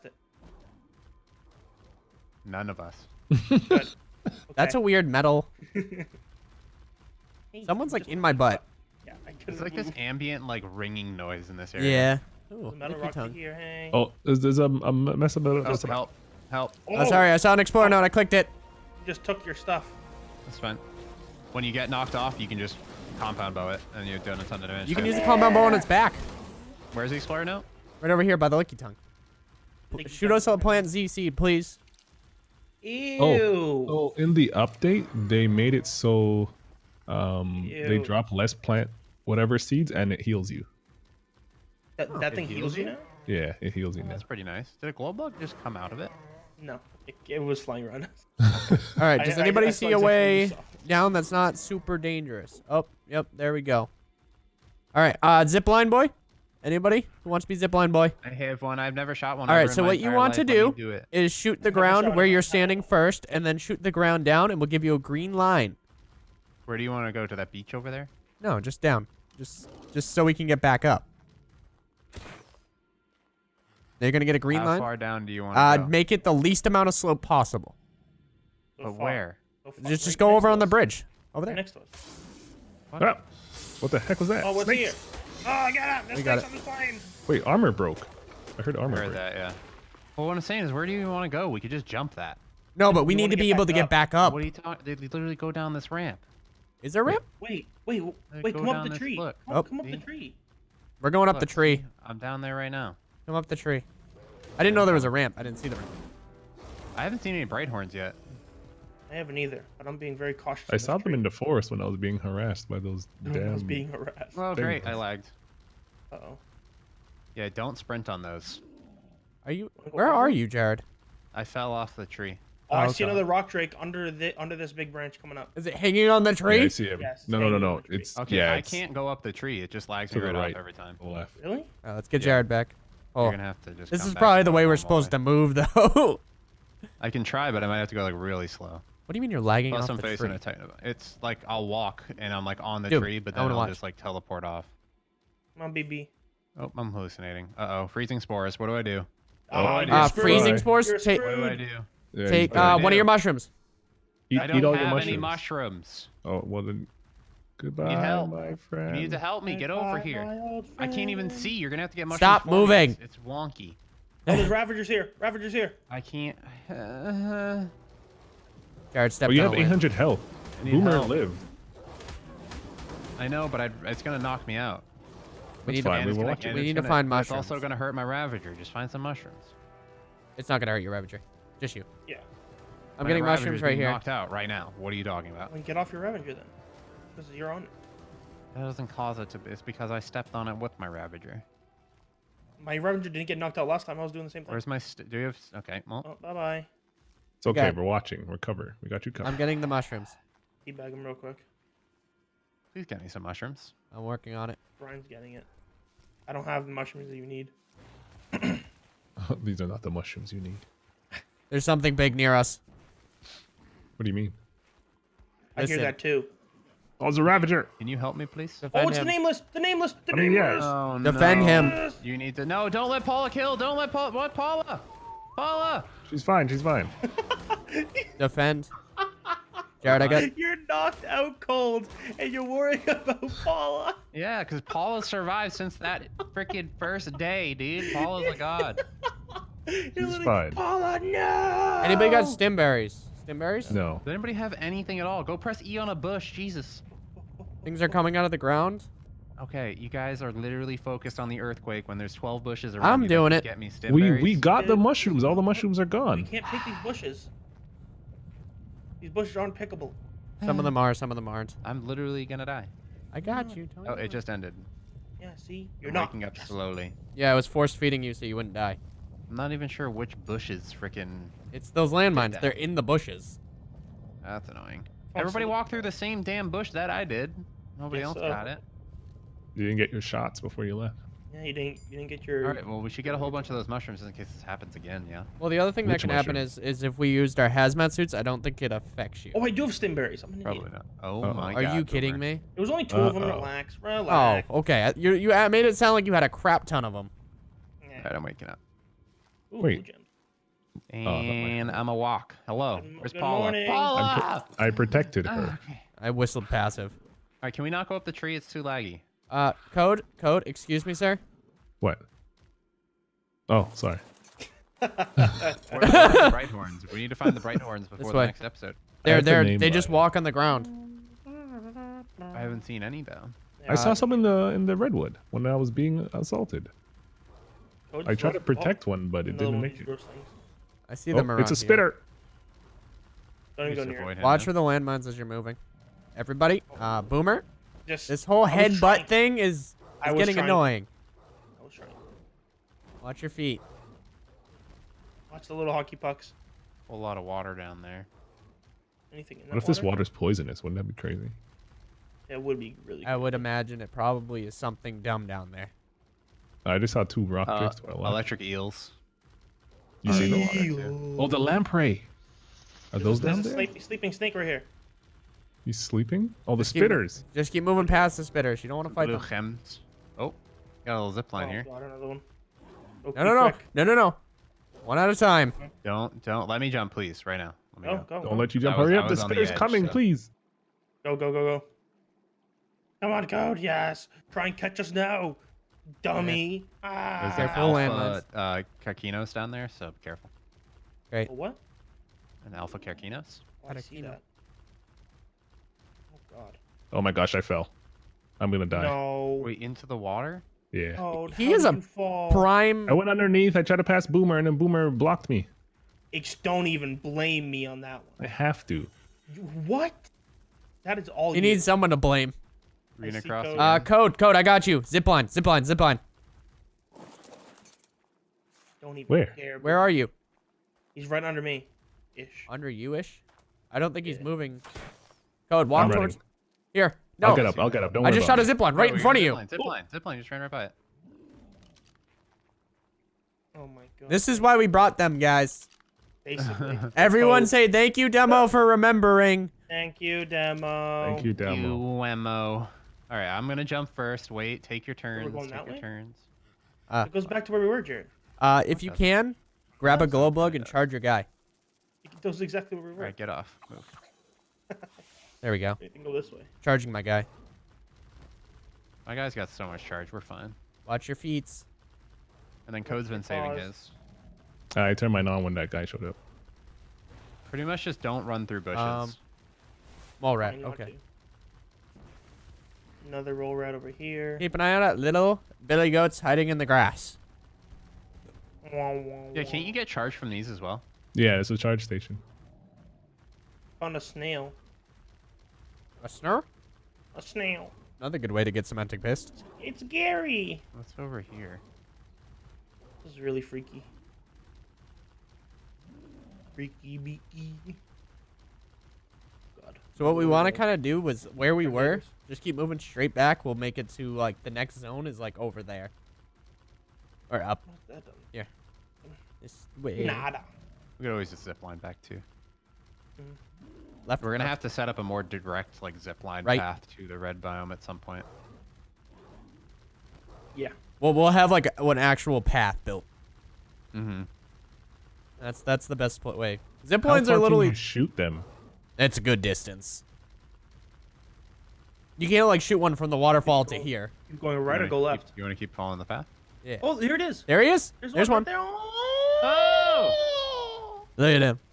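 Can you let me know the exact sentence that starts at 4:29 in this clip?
I'm not even sure which bushes freaking.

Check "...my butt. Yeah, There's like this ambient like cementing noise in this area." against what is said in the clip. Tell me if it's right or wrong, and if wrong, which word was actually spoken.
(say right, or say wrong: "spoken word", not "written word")
wrong: "ringing", not "cementing".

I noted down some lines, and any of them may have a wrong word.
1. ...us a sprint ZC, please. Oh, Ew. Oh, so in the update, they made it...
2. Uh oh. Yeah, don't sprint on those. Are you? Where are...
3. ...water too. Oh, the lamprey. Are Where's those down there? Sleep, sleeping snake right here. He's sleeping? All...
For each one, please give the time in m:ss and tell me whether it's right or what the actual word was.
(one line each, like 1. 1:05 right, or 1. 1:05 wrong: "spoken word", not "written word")
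1. 0:30 wrong: "plant", not "sprint"
2. 1:56 right
3. 6:00 wrong: "There", not "Where".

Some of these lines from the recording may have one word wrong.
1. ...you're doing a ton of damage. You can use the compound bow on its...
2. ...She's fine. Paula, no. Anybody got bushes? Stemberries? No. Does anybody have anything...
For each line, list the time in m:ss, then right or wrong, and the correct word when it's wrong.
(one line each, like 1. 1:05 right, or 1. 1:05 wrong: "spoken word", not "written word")
1. 0:24 right
2. 3:59 wrong: "stemberries", not "bushes".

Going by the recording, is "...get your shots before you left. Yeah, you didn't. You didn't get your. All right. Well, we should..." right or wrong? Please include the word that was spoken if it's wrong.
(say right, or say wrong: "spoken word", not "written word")
right.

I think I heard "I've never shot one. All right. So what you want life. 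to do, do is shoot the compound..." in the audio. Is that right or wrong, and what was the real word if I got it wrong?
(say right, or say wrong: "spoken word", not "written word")
wrong: "ground", not "compound".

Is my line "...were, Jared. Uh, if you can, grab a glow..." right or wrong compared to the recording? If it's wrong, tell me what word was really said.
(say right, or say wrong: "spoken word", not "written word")
right.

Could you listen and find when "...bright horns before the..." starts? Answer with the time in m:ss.
5:17.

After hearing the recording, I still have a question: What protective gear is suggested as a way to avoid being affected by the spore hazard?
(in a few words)
Hazmat suits.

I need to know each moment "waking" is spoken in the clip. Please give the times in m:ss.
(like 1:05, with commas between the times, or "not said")
4:26, 4:58.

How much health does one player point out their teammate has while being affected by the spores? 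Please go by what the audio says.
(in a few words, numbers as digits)
800.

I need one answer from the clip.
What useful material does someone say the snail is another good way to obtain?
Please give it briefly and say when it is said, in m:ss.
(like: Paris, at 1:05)
Cementing paste, at 8:08.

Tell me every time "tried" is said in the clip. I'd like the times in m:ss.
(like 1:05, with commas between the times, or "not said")
5:28, 6:43.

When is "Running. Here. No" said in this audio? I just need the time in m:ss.
7:06.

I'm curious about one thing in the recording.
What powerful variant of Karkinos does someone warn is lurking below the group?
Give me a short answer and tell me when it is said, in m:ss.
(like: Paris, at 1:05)
Alpha Karkinos, at 6:32.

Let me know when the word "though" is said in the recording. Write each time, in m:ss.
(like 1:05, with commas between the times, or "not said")
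2:15, 5:23.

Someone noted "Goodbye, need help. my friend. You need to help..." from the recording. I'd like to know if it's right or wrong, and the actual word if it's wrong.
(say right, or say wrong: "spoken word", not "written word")
right.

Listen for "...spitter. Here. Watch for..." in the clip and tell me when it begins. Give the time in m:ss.
5:31.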